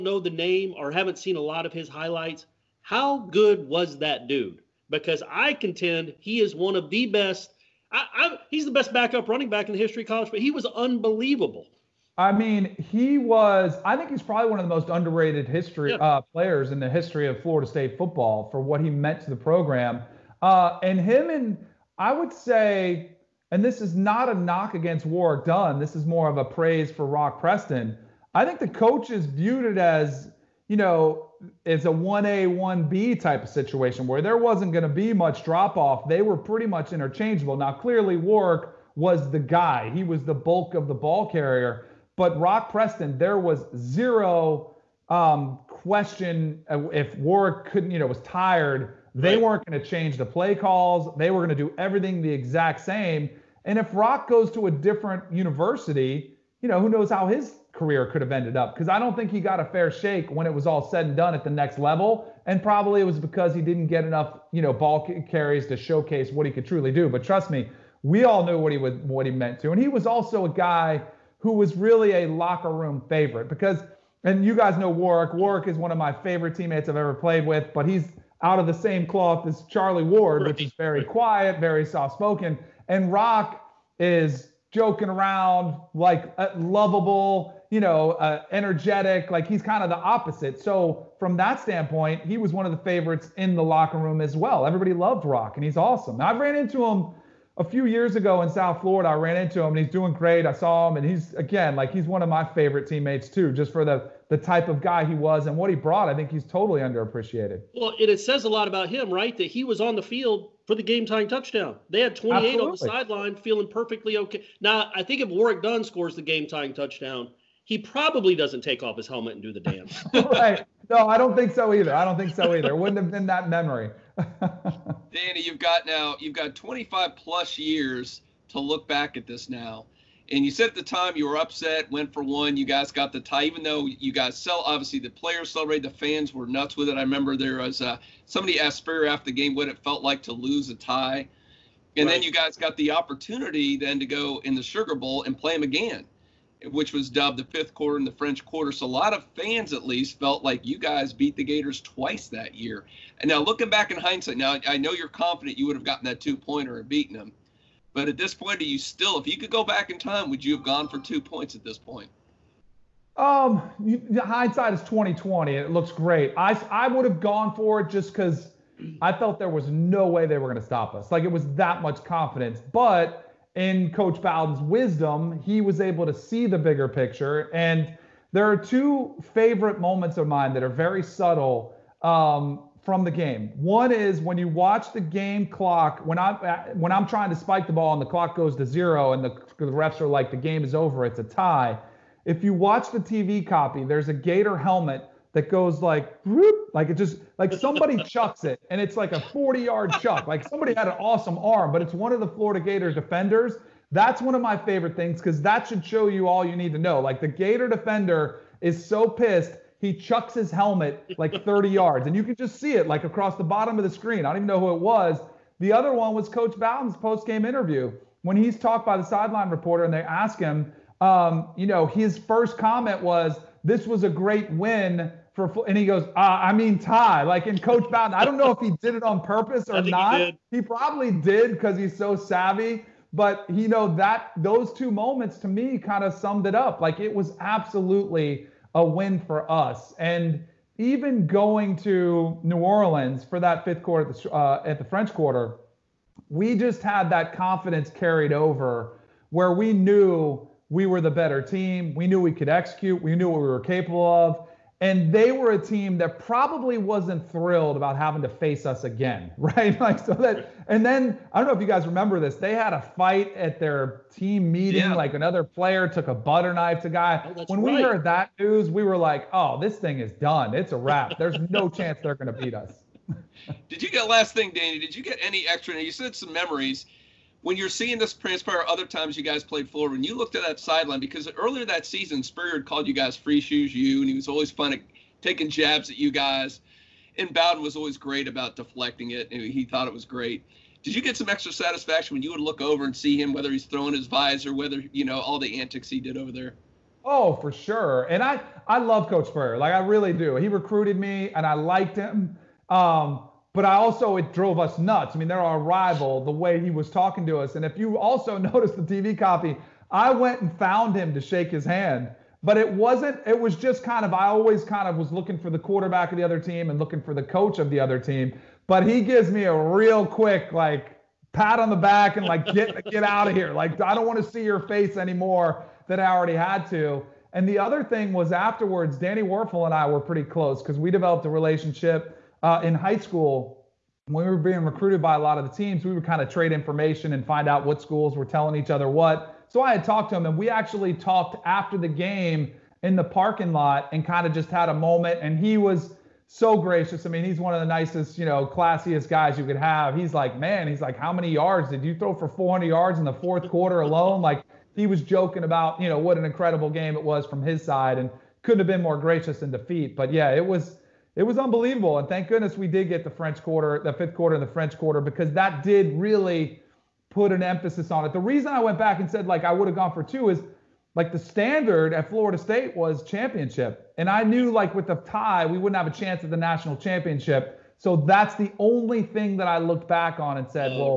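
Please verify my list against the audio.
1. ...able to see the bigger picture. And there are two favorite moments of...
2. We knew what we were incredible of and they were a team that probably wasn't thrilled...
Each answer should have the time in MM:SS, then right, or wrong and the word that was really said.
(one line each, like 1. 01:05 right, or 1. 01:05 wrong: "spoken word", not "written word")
1. 02:55 right
2. 04:13 wrong: "capable", not "incredible".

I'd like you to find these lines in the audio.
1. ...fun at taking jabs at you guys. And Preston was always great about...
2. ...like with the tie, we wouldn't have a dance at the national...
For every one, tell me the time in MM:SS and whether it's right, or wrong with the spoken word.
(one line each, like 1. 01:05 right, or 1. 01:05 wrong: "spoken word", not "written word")
1. 04:44 wrong: "Bowden", not "Preston"
2. 06:14 wrong: "chance", not "dance".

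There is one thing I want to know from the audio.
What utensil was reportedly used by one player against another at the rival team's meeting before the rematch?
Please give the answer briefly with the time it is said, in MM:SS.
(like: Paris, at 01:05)
butter knife, at 04:26.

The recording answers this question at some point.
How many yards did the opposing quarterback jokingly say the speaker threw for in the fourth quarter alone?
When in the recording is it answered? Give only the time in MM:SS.
05:52.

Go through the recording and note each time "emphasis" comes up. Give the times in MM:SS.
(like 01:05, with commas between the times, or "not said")
06:07.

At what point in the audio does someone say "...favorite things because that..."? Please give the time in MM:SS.
03:24.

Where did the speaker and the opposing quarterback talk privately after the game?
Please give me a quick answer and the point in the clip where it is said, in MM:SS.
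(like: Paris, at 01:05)
the parking lot, at 05:43.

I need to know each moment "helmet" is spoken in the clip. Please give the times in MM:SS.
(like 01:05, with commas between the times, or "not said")
01:59, 03:14, 03:30.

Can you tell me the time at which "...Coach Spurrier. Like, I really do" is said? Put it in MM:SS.
04:59.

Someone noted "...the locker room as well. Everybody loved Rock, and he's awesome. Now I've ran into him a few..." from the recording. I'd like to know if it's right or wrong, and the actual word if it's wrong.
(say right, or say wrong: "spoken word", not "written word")
right.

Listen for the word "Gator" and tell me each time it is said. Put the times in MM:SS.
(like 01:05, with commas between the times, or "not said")
02:31, 03:14, 03:22, 03:27.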